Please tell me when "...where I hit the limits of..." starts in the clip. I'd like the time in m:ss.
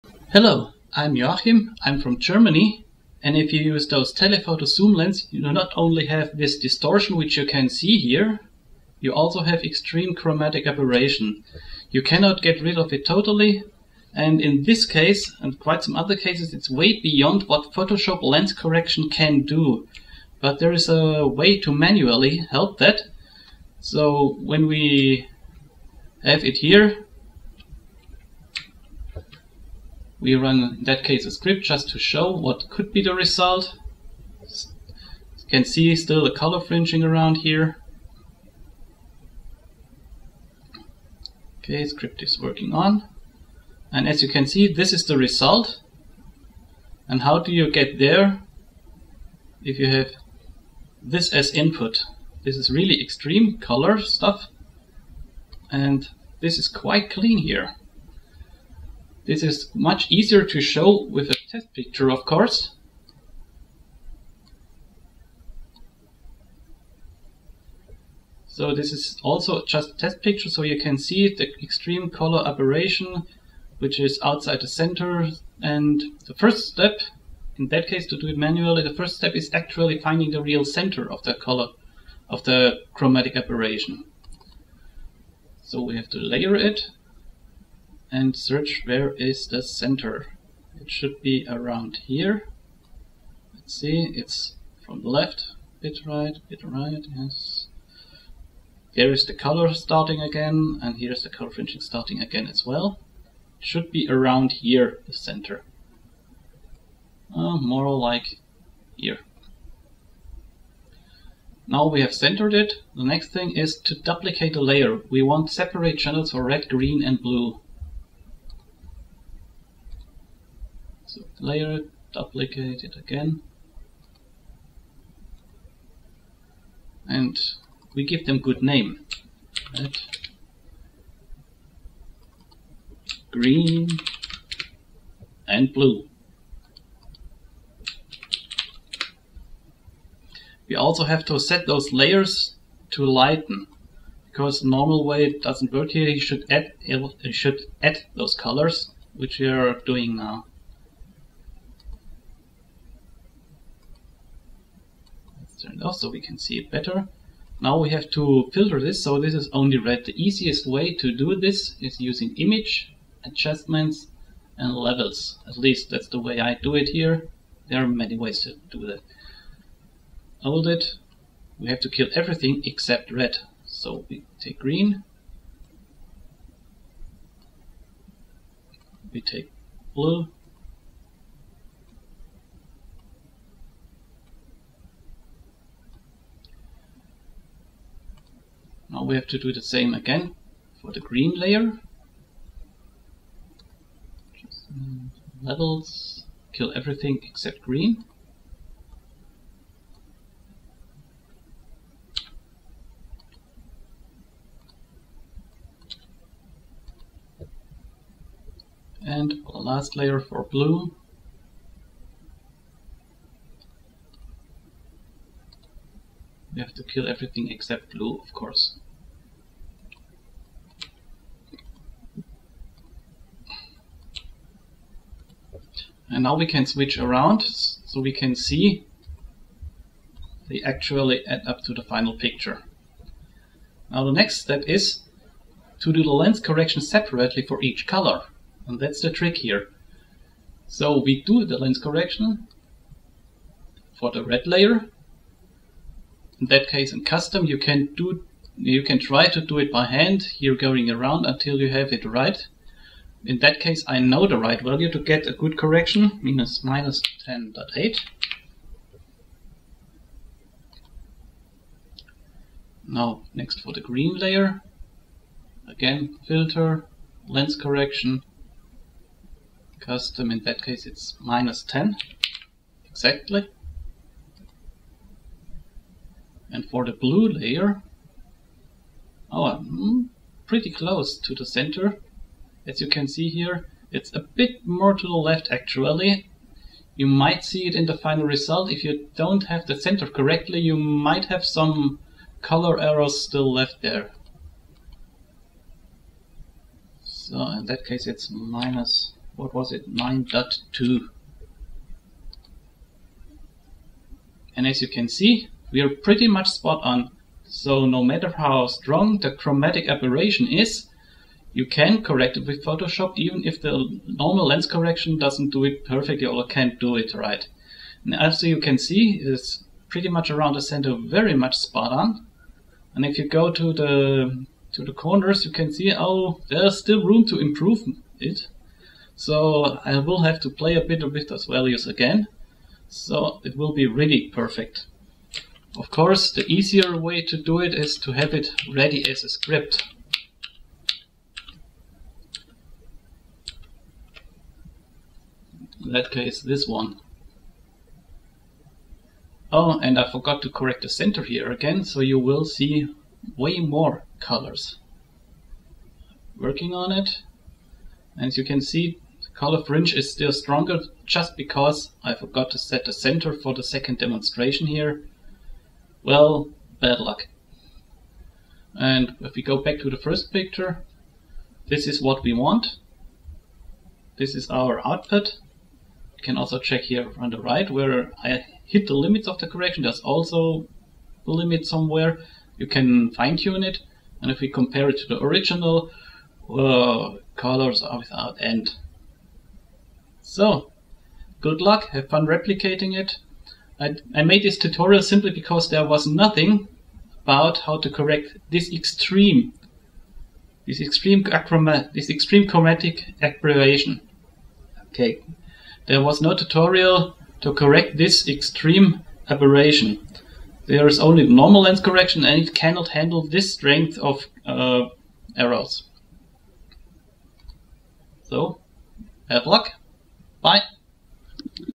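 6:17.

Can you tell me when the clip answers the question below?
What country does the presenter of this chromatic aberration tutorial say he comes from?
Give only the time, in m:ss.
0:02.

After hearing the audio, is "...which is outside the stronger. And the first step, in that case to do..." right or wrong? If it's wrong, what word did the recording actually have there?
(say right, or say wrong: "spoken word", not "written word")
wrong: "center", not "stronger".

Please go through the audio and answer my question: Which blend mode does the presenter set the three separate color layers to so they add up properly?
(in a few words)
Lighten.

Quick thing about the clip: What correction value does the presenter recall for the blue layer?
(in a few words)
-9.2.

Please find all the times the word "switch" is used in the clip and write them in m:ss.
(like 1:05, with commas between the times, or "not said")
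3:46.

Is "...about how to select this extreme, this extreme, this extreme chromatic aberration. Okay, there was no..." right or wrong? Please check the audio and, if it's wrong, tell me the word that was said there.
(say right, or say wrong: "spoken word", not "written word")
wrong: "correct", not "select".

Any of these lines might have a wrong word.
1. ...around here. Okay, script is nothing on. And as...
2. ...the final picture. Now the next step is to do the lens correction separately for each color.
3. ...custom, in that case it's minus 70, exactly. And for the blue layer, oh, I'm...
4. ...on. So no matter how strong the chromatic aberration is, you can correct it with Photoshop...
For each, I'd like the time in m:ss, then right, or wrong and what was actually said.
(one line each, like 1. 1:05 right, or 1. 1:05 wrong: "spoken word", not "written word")
1. 0:37 wrong: "working", not "nothing"
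2. 3:51 right
3. 4:29 wrong: "10", not "70"
4. 5:06 right.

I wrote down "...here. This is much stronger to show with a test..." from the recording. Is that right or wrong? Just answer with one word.
wrong.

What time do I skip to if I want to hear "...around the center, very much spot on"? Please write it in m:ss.
5:20.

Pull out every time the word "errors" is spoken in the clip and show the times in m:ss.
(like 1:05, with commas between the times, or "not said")
4:52, 6:55.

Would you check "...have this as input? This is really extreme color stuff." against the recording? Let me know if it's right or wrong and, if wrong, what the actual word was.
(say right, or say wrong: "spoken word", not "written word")
right.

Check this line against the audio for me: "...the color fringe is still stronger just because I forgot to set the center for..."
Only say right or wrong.
right.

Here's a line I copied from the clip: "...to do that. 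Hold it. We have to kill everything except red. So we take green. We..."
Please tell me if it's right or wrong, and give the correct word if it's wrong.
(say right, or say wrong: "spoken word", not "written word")
right.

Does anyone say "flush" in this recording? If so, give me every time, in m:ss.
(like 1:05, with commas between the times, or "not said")
not said.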